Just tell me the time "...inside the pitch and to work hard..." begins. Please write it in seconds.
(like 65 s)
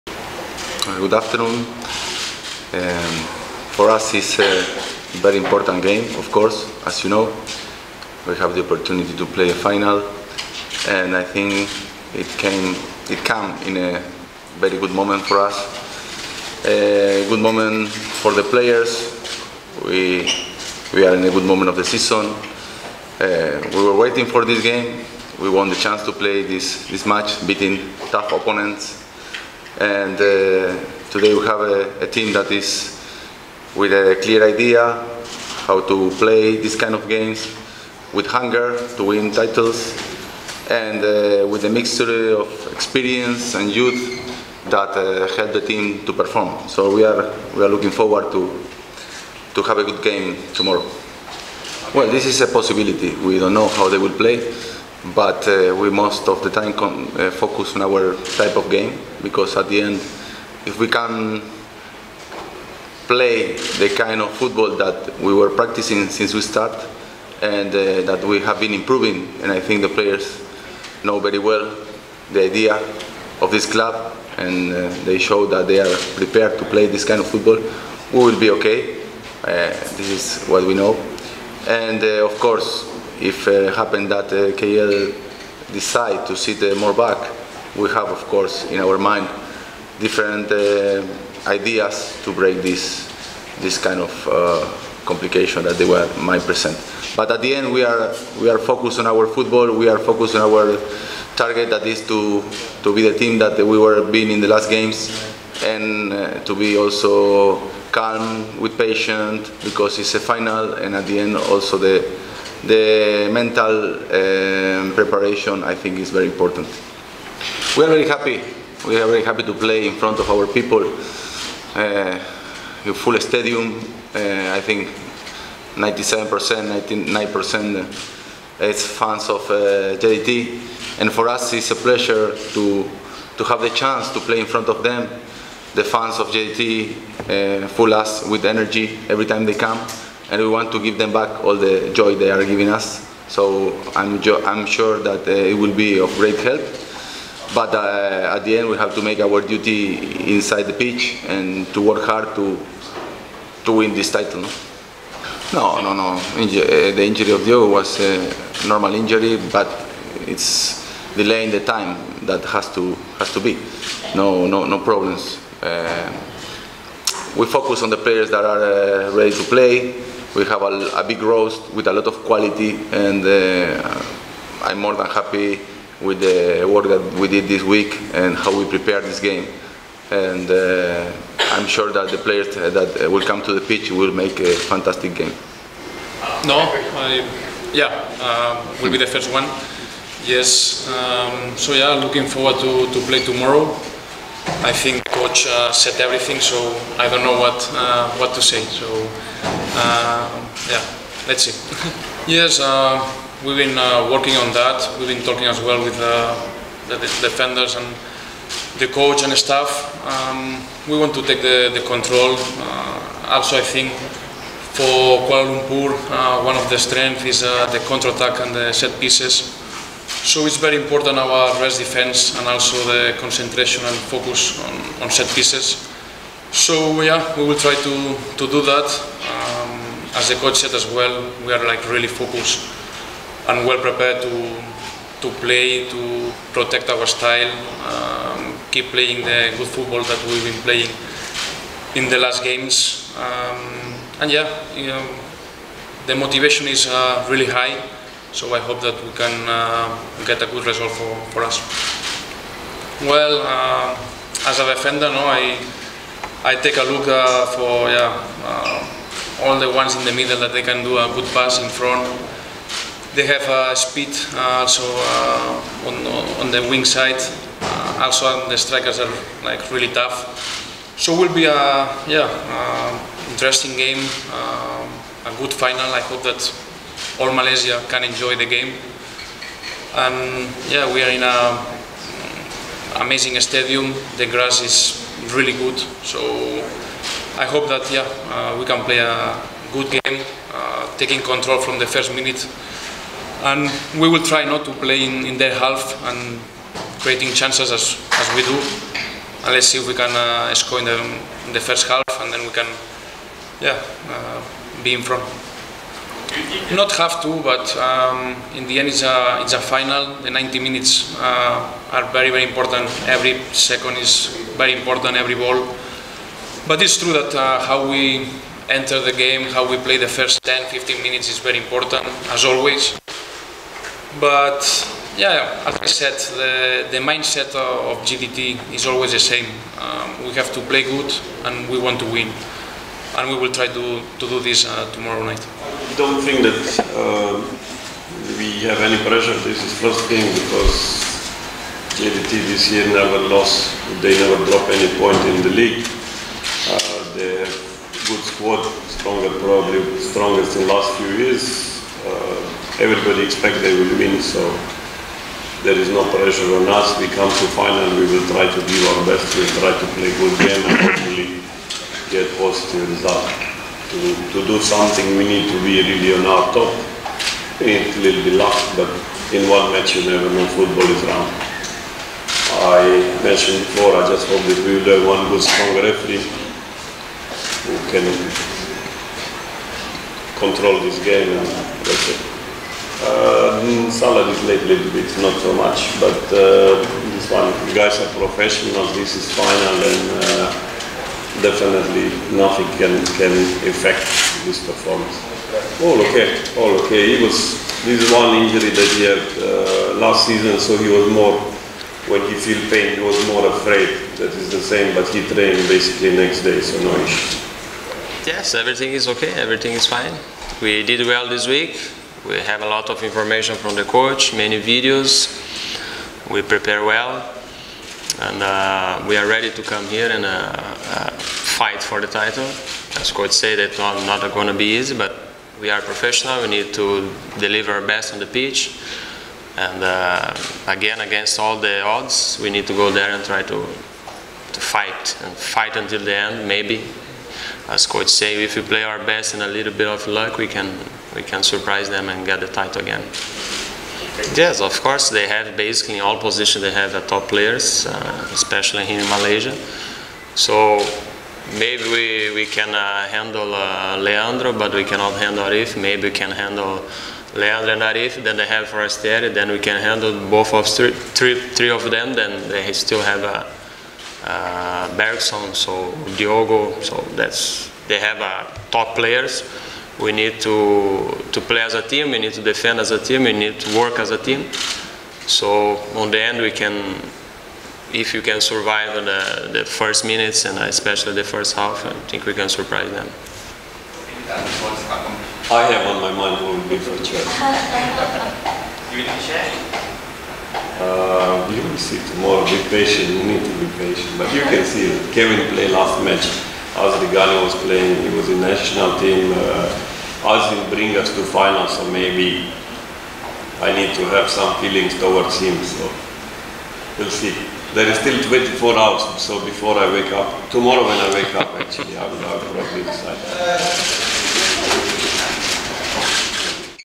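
150 s.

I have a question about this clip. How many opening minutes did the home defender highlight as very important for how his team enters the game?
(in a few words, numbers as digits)
10 to 15 minutes.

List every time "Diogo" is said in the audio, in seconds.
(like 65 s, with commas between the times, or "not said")
157 s, 466 s.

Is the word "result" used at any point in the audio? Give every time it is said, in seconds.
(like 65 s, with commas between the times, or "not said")
250 s, 362 s.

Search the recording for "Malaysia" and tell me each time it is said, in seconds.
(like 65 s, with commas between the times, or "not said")
277 s, 449 s.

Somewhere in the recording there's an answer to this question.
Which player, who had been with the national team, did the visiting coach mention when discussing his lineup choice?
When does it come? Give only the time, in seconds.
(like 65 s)
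496 s.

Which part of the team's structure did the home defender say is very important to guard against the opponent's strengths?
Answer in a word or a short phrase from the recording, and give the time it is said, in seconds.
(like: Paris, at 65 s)
rest defense, at 221 s.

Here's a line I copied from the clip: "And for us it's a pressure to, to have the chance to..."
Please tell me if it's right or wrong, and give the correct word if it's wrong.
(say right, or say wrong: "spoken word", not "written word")
wrong: "pleasure", not "pressure".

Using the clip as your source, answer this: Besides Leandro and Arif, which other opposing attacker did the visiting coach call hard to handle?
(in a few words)
Forestieri.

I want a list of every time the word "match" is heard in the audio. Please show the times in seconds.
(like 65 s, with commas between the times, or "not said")
27 s, 369 s, 496 s.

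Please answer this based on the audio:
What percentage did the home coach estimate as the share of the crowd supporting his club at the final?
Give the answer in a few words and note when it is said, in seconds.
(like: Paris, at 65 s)
99%, at 126 s.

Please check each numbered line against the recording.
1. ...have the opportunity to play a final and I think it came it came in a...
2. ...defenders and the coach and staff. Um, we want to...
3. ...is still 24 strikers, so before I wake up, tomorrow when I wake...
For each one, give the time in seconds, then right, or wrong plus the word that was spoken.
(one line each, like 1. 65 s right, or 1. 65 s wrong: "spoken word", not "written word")
1. 8 s right
2. 207 s right
3. 507 s wrong: "hours", not "strikers".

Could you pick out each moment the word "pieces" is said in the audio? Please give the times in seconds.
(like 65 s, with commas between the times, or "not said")
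218 s, 225 s.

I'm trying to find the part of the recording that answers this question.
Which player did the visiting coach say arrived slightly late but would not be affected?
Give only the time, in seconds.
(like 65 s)
383 s.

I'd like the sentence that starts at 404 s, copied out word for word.
That is the same, but he trained basically next day, so no issue yes, everything is okay, everything is fine.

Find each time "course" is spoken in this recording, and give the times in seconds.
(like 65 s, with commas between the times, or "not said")
6 s, 82 s, 88 s, 444 s.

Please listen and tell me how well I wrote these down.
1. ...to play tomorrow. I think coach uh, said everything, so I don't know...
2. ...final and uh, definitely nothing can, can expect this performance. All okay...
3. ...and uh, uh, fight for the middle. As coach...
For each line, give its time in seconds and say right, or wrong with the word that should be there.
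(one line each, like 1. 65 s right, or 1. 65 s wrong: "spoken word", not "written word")
1. 192 s right
2. 389 s wrong: "affect", not "expect"
3. 420 s wrong: "title", not "middle".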